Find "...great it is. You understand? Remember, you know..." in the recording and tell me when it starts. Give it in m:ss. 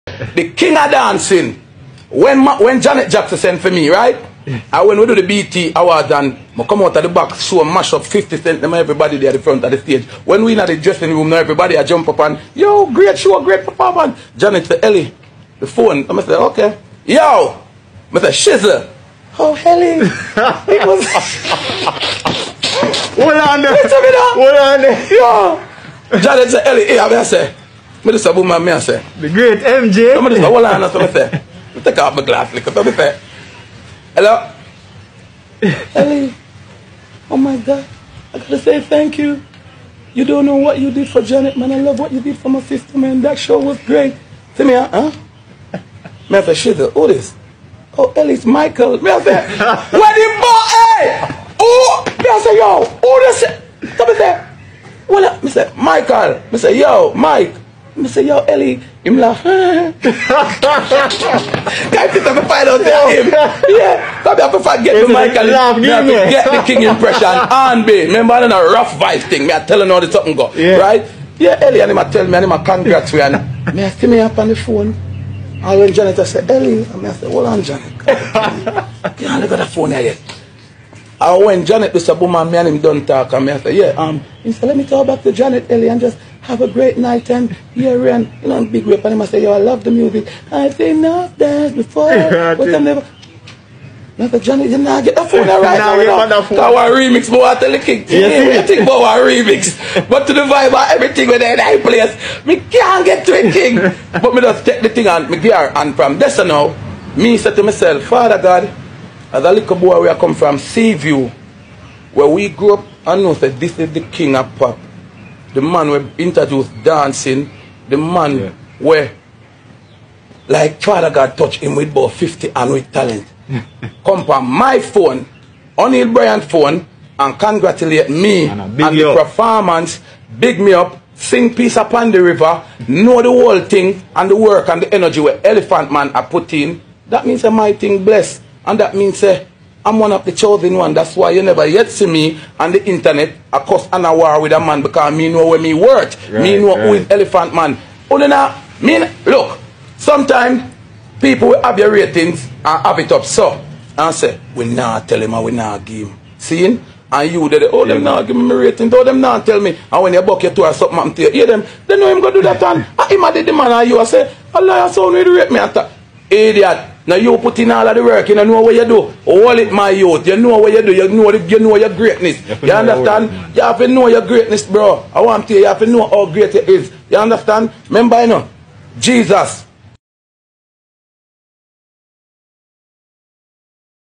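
2:56.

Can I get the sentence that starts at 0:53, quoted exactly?
So me say, well, me say, Michael.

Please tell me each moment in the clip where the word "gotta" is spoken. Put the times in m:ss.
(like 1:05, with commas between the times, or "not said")
0:38.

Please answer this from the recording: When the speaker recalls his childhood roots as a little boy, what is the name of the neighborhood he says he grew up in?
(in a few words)
Seaview.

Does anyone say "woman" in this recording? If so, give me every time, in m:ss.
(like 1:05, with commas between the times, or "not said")
1:22.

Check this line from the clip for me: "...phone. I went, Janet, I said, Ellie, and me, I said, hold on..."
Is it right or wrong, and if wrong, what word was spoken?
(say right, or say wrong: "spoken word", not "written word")
right.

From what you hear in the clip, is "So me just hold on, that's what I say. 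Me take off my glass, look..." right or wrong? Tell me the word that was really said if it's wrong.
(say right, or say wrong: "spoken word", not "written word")
right.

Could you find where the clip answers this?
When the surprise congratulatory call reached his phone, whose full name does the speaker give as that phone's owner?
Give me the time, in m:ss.
2:05.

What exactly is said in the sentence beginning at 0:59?
Kan je het provide out there him?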